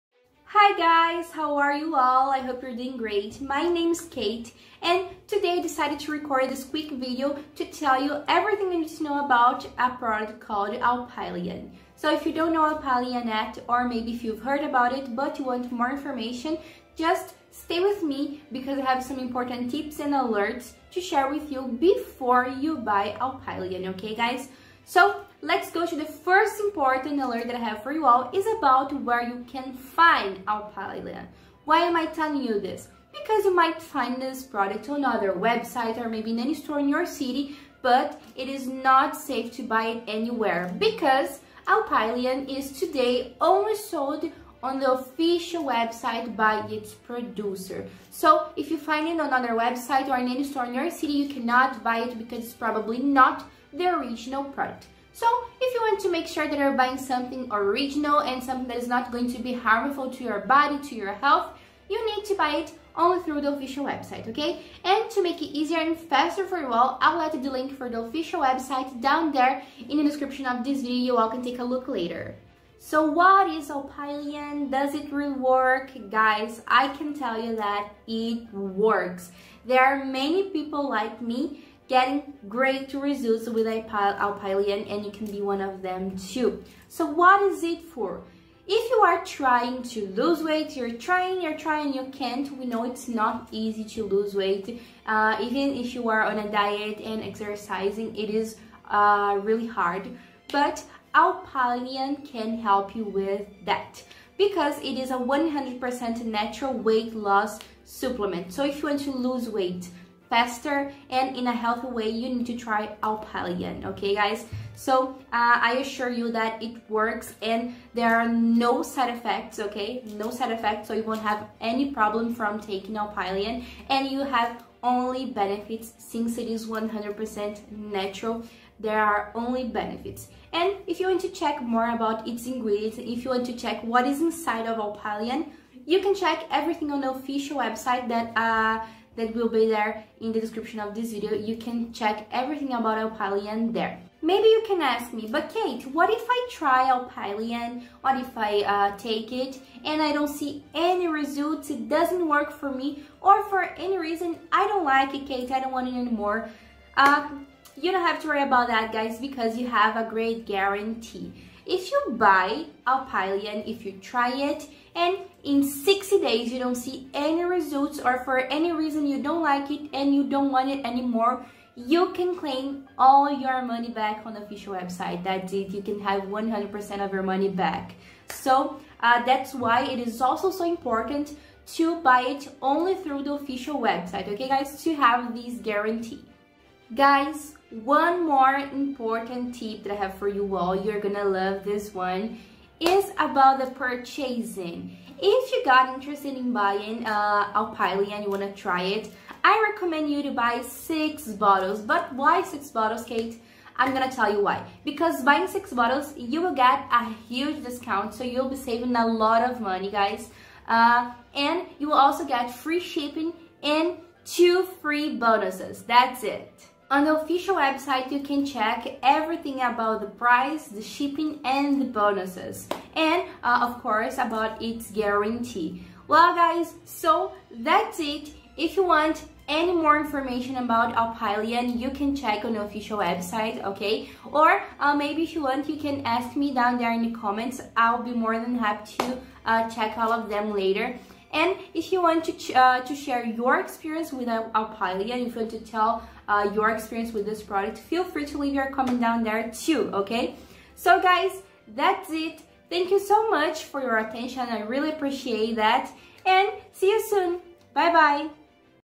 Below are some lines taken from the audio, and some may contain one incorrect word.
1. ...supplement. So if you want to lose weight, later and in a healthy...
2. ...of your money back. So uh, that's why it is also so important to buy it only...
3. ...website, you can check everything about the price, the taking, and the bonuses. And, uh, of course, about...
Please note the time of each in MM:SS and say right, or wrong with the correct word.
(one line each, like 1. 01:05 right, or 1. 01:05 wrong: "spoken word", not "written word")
1. 01:47 wrong: "faster", not "later"
2. 02:57 right
3. 03:37 wrong: "shipping", not "taking".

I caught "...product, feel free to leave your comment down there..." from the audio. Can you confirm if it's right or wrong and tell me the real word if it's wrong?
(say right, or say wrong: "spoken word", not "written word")
right.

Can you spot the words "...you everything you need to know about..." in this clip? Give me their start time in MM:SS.
00:08.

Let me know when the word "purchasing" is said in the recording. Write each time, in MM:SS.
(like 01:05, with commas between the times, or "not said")
03:13.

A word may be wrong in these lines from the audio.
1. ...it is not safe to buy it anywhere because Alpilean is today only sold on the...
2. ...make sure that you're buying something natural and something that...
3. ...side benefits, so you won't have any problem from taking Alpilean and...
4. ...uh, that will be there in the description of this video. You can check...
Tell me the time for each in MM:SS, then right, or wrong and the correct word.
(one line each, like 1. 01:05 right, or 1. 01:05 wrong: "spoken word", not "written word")
1. 00:38 right
2. 00:56 wrong: "original", not "natural"
3. 02:00 wrong: "effects", not "benefits"
4. 02:18 right.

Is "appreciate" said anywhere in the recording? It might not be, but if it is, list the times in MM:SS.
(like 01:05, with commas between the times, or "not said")
04:14.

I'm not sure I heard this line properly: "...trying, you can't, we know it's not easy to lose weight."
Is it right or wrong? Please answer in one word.
right.